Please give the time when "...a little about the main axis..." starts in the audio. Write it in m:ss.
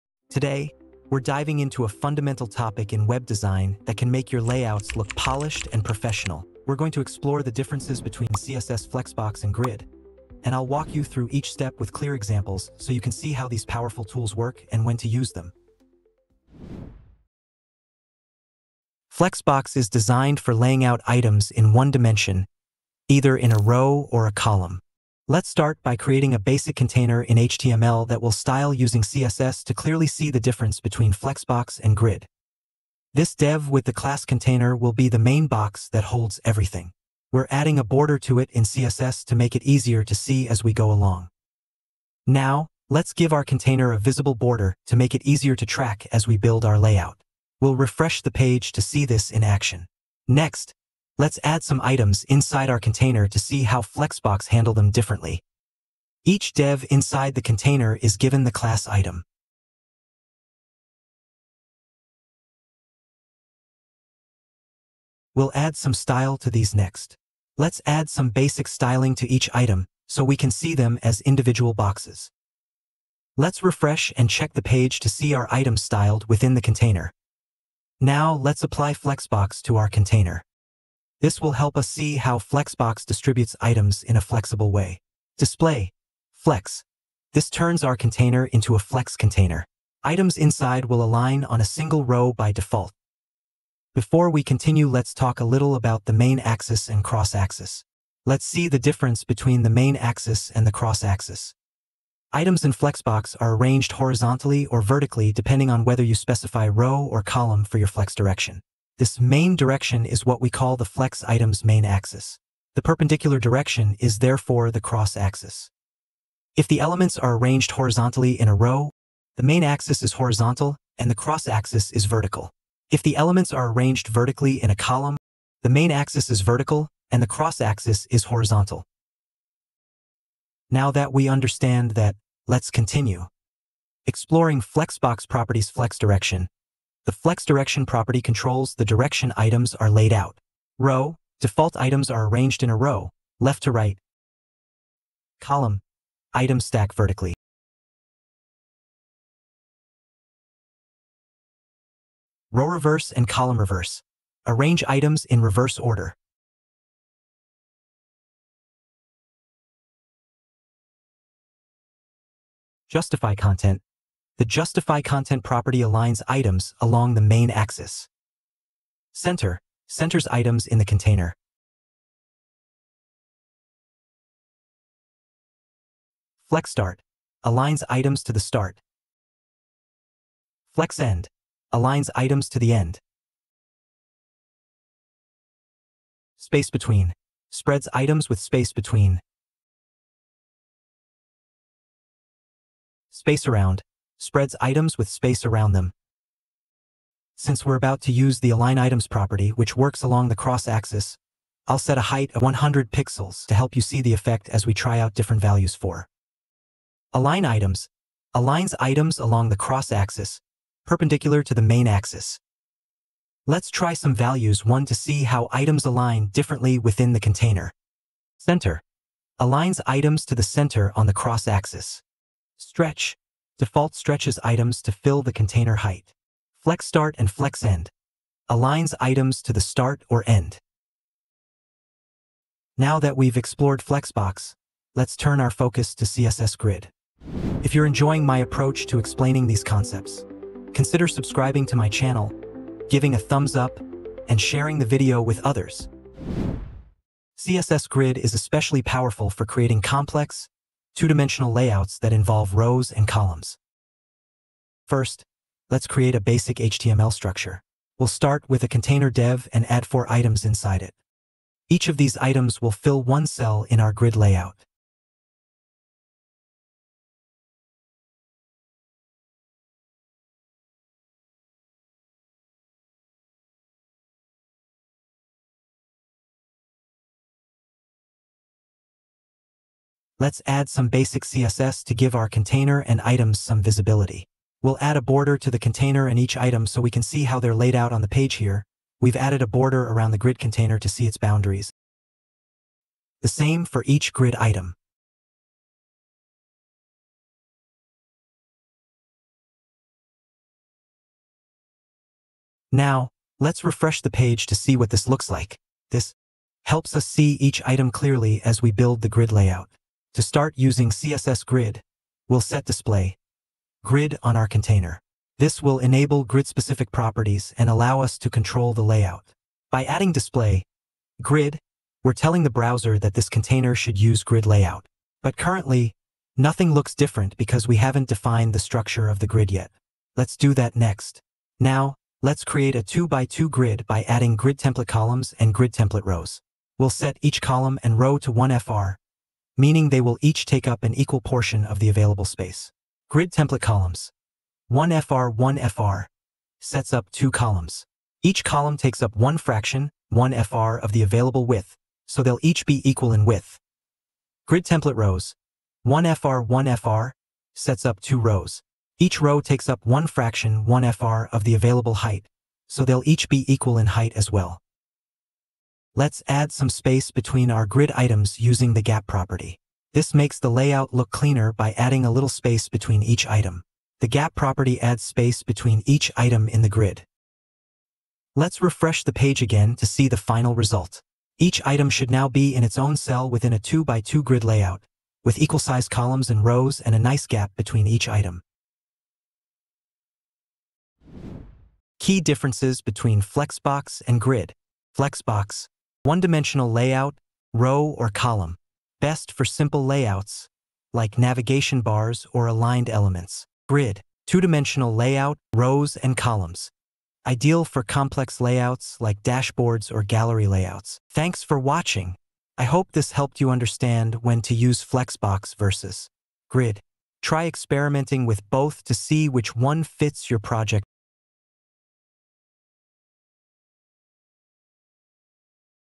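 1:35.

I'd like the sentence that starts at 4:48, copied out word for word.
We've added a border around the grid container to see its boundaries.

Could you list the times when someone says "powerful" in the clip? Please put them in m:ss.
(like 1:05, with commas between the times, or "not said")
0:13, 4:08.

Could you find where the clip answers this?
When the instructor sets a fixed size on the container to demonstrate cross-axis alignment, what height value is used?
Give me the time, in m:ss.
3:22.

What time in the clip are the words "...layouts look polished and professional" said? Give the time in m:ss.
0:04.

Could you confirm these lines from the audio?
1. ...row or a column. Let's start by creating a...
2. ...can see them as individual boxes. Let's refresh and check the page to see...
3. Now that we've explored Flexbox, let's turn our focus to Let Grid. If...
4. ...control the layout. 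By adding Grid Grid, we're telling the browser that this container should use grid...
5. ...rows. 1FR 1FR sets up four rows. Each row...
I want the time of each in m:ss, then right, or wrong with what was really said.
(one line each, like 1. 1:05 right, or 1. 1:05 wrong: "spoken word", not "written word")
1. 0:23 right
2. 1:10 right
3. 3:52 wrong: "CSS", not "Let"
4. 5:18 wrong: "Display", not "Grid"
5. 5:54 wrong: "two", not "four".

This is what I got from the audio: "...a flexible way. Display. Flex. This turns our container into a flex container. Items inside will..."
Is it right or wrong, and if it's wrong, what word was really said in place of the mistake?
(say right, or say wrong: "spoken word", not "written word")
right.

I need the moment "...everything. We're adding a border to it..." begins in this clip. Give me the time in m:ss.
0:36.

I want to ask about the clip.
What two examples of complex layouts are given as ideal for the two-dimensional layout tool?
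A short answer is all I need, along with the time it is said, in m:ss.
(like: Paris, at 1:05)
dashboards or gallery layouts, at 6:49.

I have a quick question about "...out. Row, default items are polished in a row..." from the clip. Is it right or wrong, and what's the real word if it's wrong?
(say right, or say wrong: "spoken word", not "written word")
wrong: "arranged", not "polished".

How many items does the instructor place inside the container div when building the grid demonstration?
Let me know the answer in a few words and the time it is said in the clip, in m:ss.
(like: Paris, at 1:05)
4, at 4:19.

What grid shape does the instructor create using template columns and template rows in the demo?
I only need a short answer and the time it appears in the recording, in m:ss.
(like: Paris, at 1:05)
2x2, at 5:32.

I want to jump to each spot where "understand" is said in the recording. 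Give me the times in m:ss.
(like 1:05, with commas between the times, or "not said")
2:11, 6:53.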